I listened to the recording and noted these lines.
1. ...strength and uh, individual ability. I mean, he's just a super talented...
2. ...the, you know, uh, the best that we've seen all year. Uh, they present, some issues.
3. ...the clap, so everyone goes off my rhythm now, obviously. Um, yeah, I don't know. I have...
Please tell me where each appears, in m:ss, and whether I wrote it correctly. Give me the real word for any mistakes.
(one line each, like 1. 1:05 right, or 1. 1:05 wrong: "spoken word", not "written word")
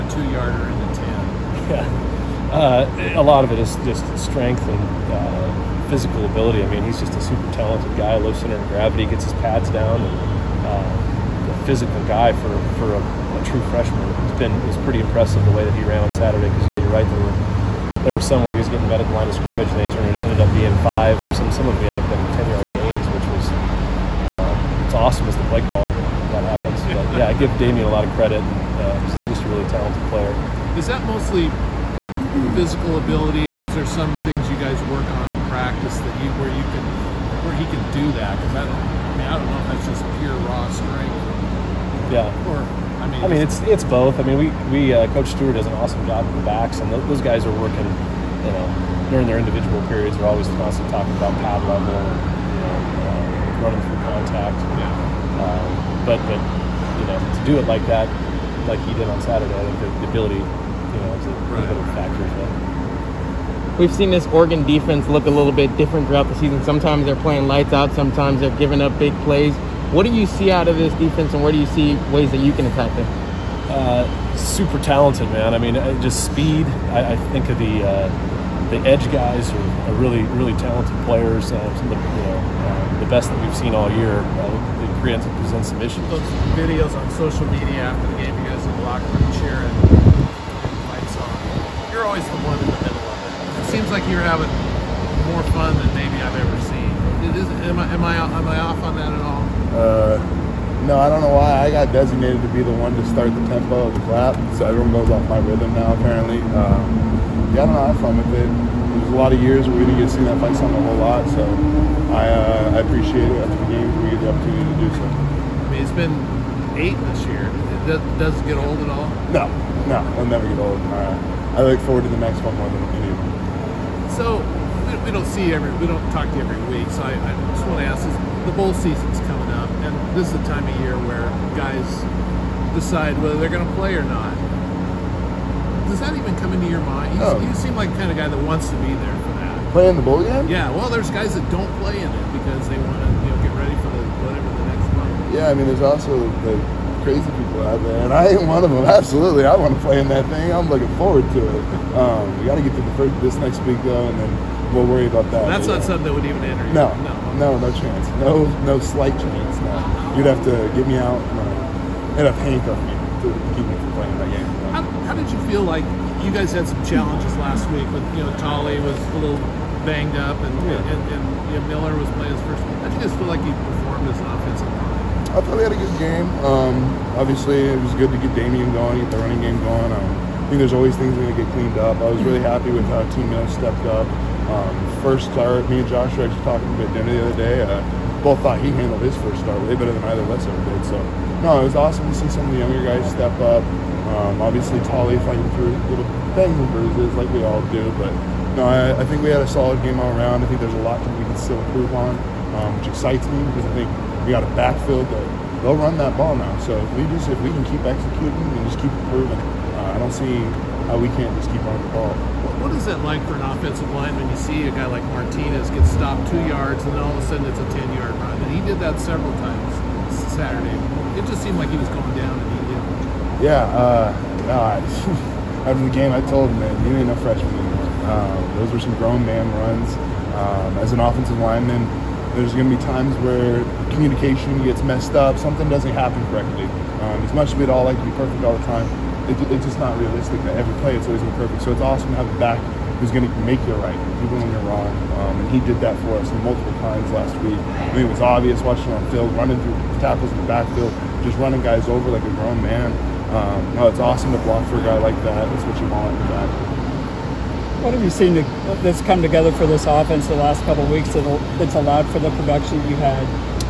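1. 0:04 wrong: "physical", not "individual"
2. 1:21 right
3. 1:43 wrong: "apparently", not "obviously".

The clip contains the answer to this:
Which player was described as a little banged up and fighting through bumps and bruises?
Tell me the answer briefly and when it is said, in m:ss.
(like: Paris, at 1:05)
Tolly, at 2:48.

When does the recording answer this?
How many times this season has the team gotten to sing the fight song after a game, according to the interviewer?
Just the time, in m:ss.
1:56.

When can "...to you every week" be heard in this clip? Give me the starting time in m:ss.
2:06.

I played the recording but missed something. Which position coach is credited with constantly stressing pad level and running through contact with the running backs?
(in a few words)
Coach Stewart.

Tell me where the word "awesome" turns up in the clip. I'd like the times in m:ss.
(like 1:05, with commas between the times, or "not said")
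0:24, 0:45, 3:11, 4:01, 4:13.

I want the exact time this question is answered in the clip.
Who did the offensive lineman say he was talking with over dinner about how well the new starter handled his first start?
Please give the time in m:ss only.
3:05.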